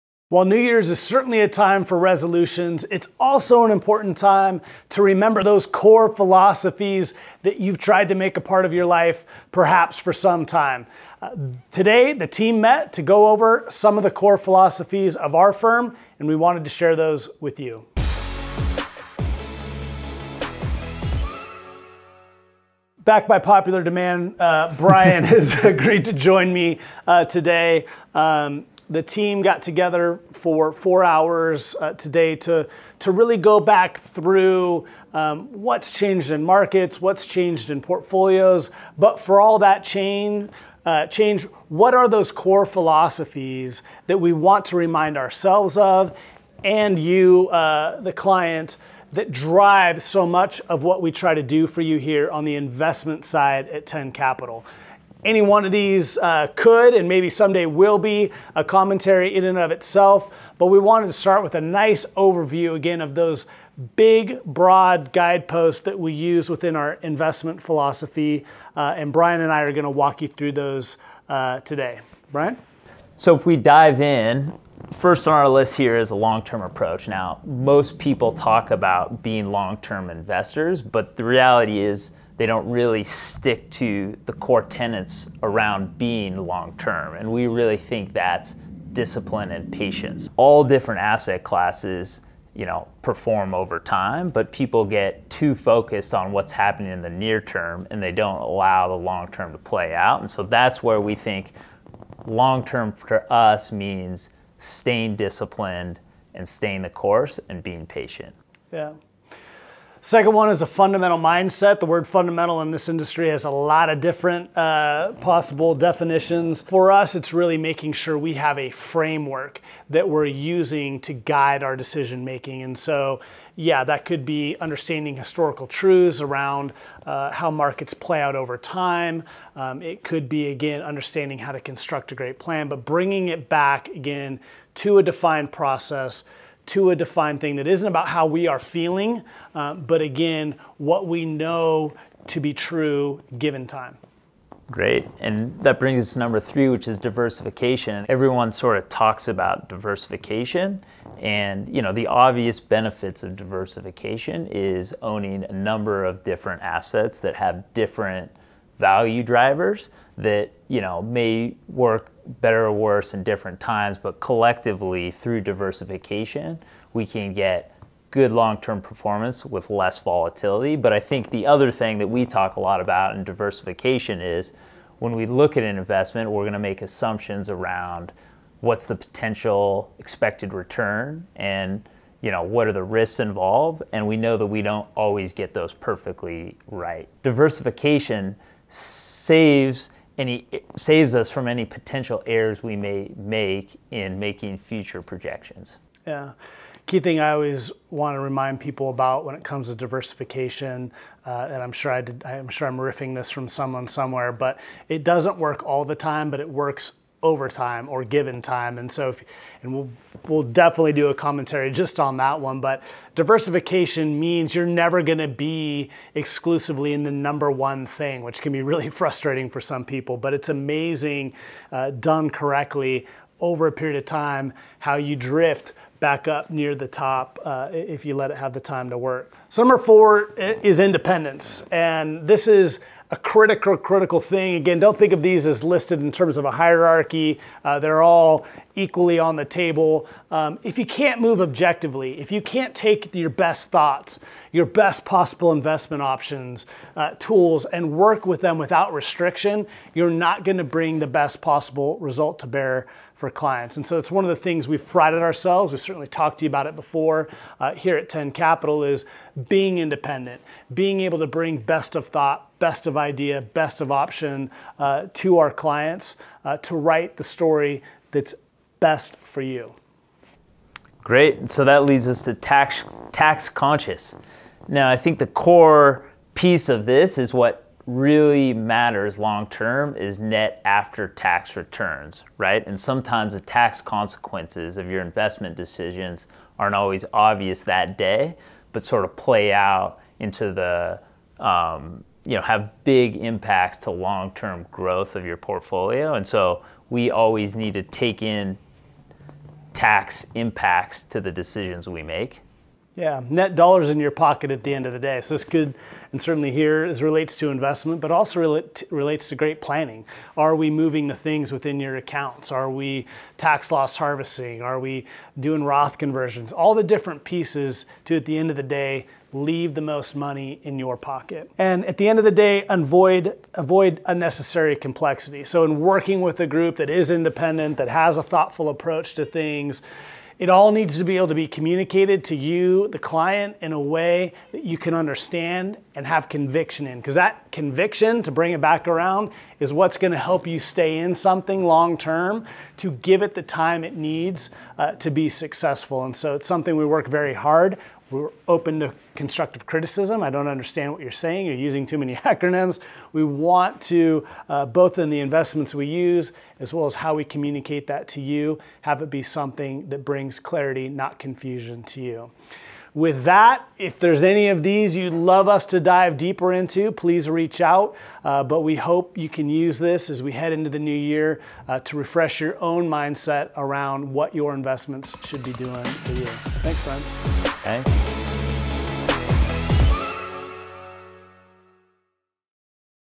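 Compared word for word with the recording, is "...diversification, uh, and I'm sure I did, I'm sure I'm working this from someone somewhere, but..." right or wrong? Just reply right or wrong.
wrong.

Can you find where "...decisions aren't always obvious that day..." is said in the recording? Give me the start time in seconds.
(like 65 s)
285 s.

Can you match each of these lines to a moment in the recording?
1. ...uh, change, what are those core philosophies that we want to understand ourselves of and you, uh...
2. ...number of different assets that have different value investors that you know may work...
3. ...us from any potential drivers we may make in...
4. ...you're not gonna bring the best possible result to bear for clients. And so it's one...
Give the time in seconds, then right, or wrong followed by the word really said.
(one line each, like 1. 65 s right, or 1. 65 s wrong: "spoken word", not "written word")
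1. 40 s wrong: "remind", not "understand"
2. 155 s wrong: "drivers", not "investors"
3. 191 s wrong: "errors", not "drivers"
4. 249 s right.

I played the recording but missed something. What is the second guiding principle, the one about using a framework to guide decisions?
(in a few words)
Fundamental mindset.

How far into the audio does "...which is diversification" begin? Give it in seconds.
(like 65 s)
146 s.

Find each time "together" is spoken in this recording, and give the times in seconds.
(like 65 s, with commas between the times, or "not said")
29 s.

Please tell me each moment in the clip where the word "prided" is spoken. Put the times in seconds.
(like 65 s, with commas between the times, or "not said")
254 s.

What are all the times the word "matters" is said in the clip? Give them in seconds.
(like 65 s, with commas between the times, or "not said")
278 s.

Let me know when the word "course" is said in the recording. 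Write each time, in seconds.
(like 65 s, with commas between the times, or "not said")
106 s.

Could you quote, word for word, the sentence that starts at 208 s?
And so, if, and we'll, we'll definitely do a commentary just on that one.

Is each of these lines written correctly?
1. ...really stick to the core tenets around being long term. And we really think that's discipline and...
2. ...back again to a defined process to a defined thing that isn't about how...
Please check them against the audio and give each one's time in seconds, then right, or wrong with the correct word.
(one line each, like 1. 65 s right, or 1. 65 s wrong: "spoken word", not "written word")
1. 82 s right
2. 133 s right.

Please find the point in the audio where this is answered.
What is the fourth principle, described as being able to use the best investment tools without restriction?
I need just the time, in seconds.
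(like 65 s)
230 s.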